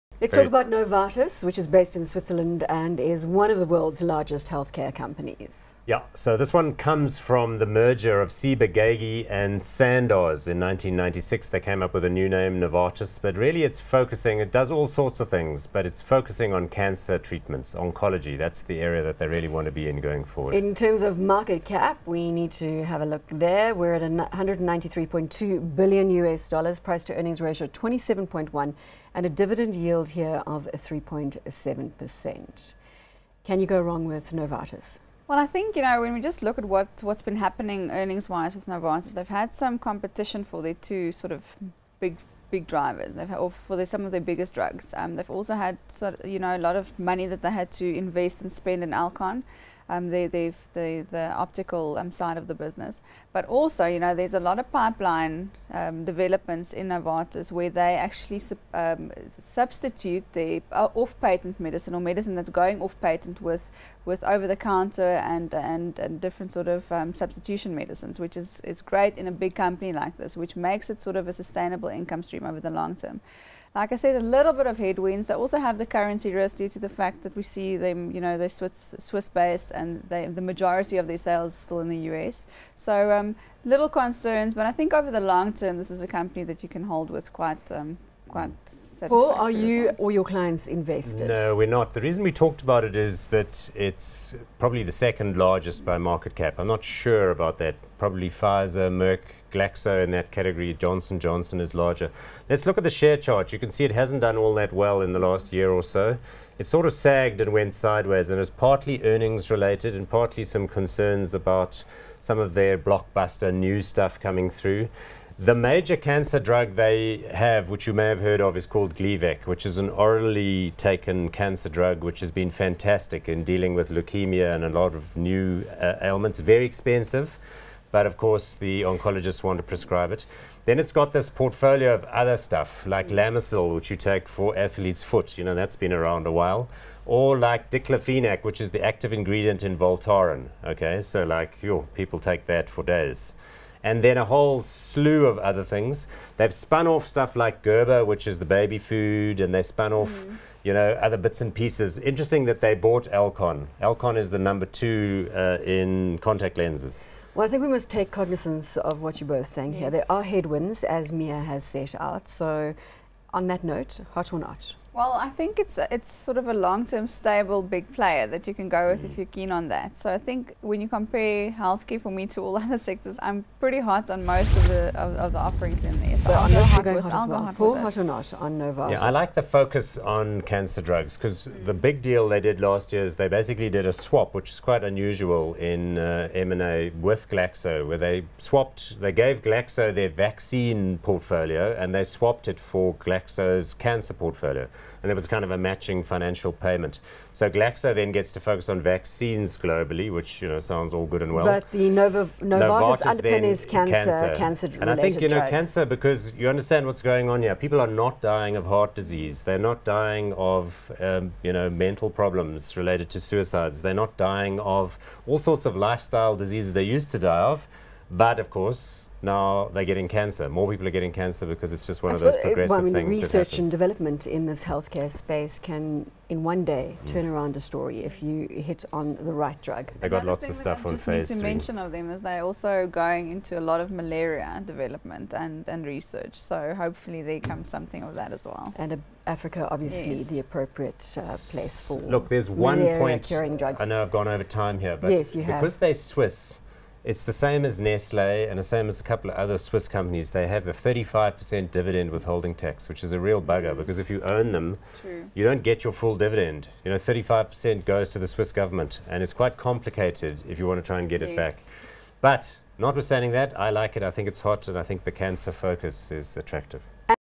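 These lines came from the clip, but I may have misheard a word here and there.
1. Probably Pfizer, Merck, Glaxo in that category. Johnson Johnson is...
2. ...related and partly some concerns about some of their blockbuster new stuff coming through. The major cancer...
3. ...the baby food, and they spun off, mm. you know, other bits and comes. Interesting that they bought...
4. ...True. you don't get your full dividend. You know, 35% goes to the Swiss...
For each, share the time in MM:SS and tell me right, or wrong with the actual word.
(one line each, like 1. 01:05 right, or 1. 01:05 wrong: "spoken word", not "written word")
1. 01:37 right
2. 01:49 right
3. 02:28 wrong: "pieces", not "comes"
4. 04:15 right.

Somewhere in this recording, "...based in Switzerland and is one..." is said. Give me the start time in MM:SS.
00:01.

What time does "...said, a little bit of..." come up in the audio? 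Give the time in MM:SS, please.
01:13.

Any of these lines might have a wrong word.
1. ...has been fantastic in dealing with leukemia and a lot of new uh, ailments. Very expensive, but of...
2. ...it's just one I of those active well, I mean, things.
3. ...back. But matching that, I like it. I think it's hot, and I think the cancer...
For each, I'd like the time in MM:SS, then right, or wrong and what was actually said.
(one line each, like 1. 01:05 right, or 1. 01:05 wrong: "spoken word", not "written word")
1. 02:02 right
2. 03:41 wrong: "progressive", not "active"
3. 04:21 wrong: "notwithstanding", not "matching".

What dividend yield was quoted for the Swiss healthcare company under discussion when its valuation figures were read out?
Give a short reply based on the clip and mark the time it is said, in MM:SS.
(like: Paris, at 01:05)
3.7%, at 00:30.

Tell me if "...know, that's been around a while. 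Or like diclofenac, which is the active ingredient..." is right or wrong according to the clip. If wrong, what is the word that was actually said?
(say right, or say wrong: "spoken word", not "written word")
right.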